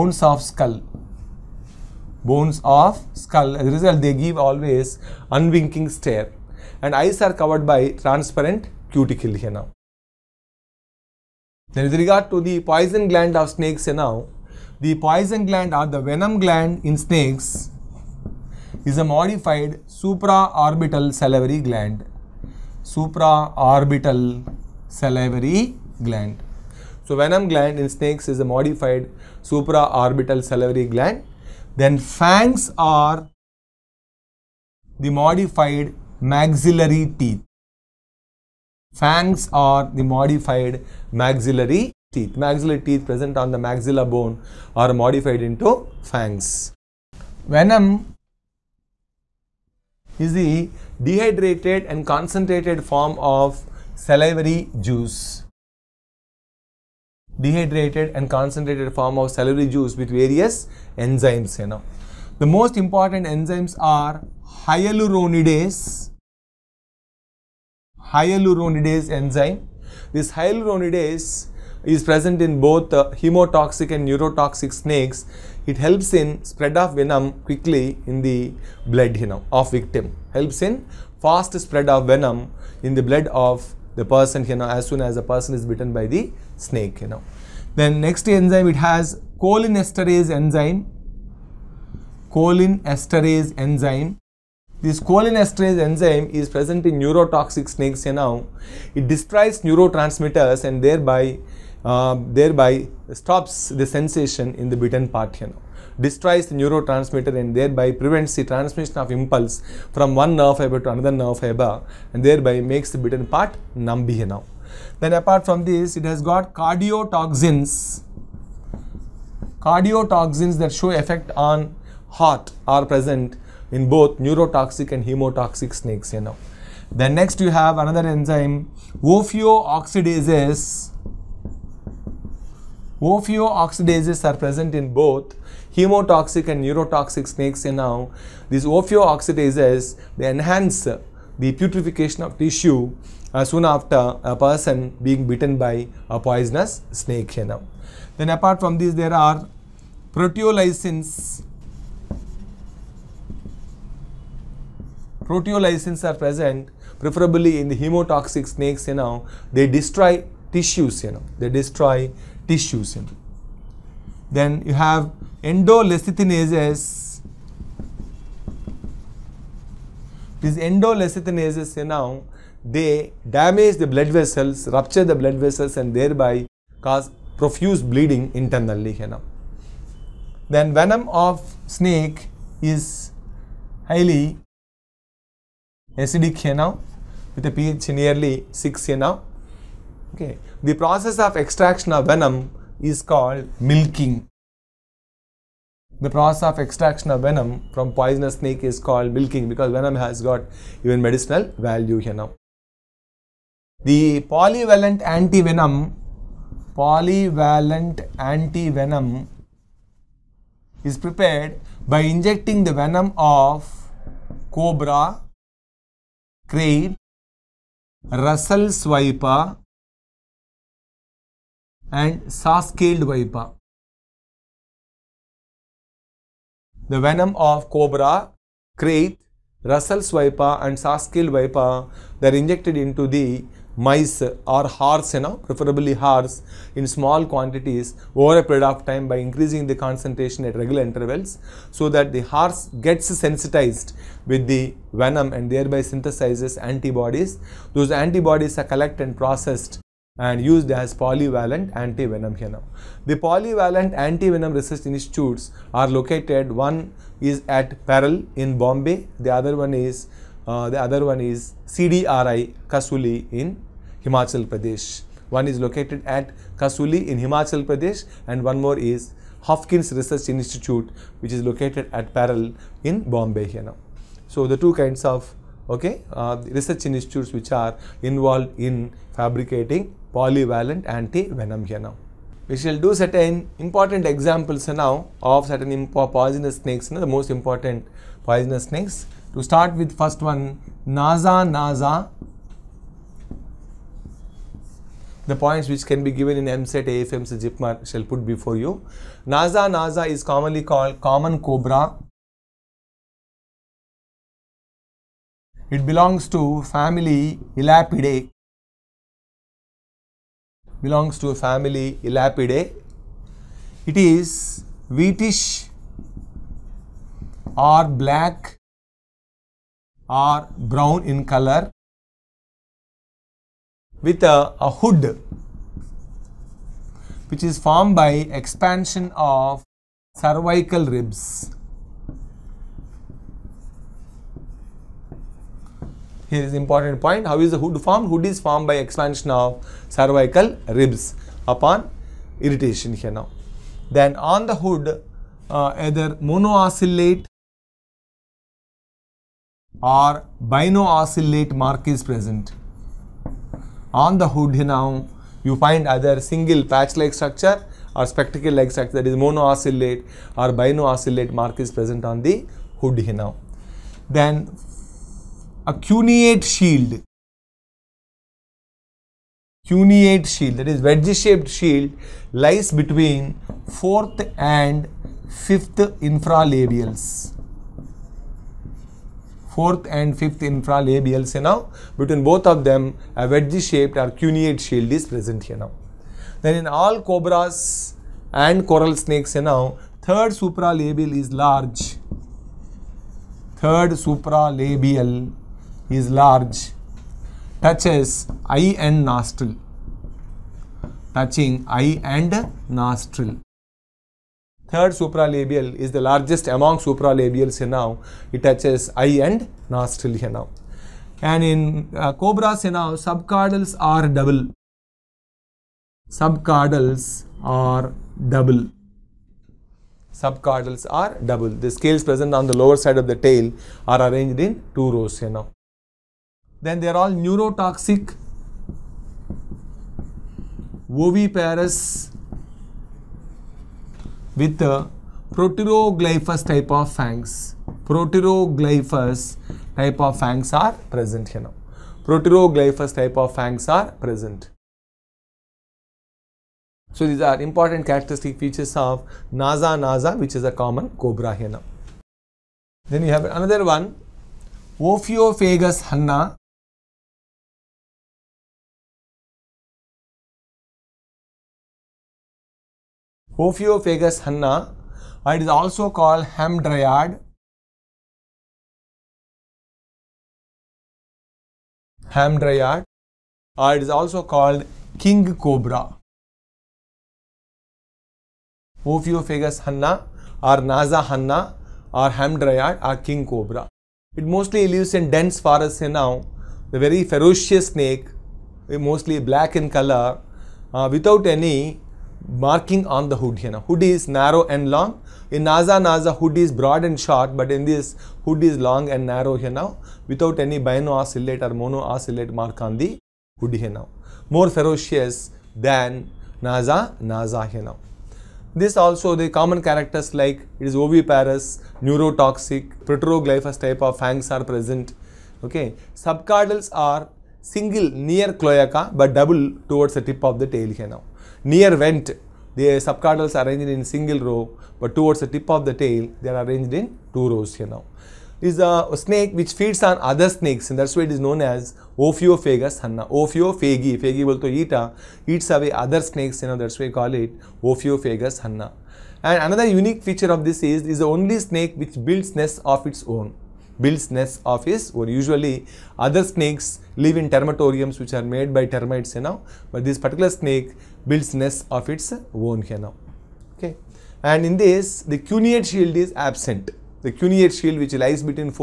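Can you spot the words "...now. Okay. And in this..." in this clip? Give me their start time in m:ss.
9:12.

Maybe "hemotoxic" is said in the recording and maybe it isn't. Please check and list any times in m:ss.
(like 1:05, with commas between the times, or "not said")
1:13, 2:05, 2:15, 2:37.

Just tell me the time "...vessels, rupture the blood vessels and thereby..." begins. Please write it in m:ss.
2:54.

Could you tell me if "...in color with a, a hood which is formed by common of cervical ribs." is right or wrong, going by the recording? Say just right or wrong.
wrong.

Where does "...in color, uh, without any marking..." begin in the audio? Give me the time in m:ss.
8:09.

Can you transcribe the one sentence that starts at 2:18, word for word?
These ophiooxidases, they enhance the putrefaction of tissue uh, soon after a person being bitten by a poisonous snake, you know.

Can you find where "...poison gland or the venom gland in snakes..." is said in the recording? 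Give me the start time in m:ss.
0:14.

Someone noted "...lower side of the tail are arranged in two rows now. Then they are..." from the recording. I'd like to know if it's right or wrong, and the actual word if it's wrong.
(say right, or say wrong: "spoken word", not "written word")
right.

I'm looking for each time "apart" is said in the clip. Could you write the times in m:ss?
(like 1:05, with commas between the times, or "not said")
1:55, 2:28.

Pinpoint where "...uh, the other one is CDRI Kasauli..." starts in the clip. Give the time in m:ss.
4:20.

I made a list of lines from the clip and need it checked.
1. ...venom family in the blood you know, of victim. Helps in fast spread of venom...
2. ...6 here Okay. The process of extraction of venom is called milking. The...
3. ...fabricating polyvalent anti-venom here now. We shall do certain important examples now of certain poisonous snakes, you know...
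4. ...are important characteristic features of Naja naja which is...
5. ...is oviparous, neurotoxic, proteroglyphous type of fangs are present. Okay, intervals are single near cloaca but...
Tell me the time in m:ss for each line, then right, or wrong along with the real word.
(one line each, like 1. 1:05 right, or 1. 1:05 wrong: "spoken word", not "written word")
1. 1:16 wrong: "quickly", not "family"
2. 3:08 right
3. 4:39 right
4. 7:27 right
5. 8:30 wrong: "subcaudals", not "intervals".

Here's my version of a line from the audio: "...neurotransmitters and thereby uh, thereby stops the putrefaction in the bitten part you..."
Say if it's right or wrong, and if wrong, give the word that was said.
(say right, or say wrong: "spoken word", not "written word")
wrong: "sensation", not "putrefaction".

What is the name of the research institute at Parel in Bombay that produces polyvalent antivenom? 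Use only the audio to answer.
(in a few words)
Hopkins Research Institute.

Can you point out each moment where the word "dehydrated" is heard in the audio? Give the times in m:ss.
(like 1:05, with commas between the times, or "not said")
0:51, 0:57.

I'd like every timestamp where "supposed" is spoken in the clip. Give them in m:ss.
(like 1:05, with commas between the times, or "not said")
not said.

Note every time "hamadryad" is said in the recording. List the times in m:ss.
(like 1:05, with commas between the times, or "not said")
7:46, 7:52, 8:02.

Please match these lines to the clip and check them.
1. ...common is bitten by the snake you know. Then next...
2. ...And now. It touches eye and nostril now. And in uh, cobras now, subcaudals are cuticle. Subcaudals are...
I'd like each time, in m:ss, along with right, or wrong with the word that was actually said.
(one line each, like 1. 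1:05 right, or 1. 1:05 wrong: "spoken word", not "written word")
1. 1:25 wrong: "person", not "common"
2. 6:46 wrong: "double", not "cuticle".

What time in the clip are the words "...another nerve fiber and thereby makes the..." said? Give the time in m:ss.
1:50.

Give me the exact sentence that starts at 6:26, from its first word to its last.
Then in all cobras and coral snakes now, third supralabial is large.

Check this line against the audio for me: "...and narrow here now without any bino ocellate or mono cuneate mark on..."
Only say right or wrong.
wrong.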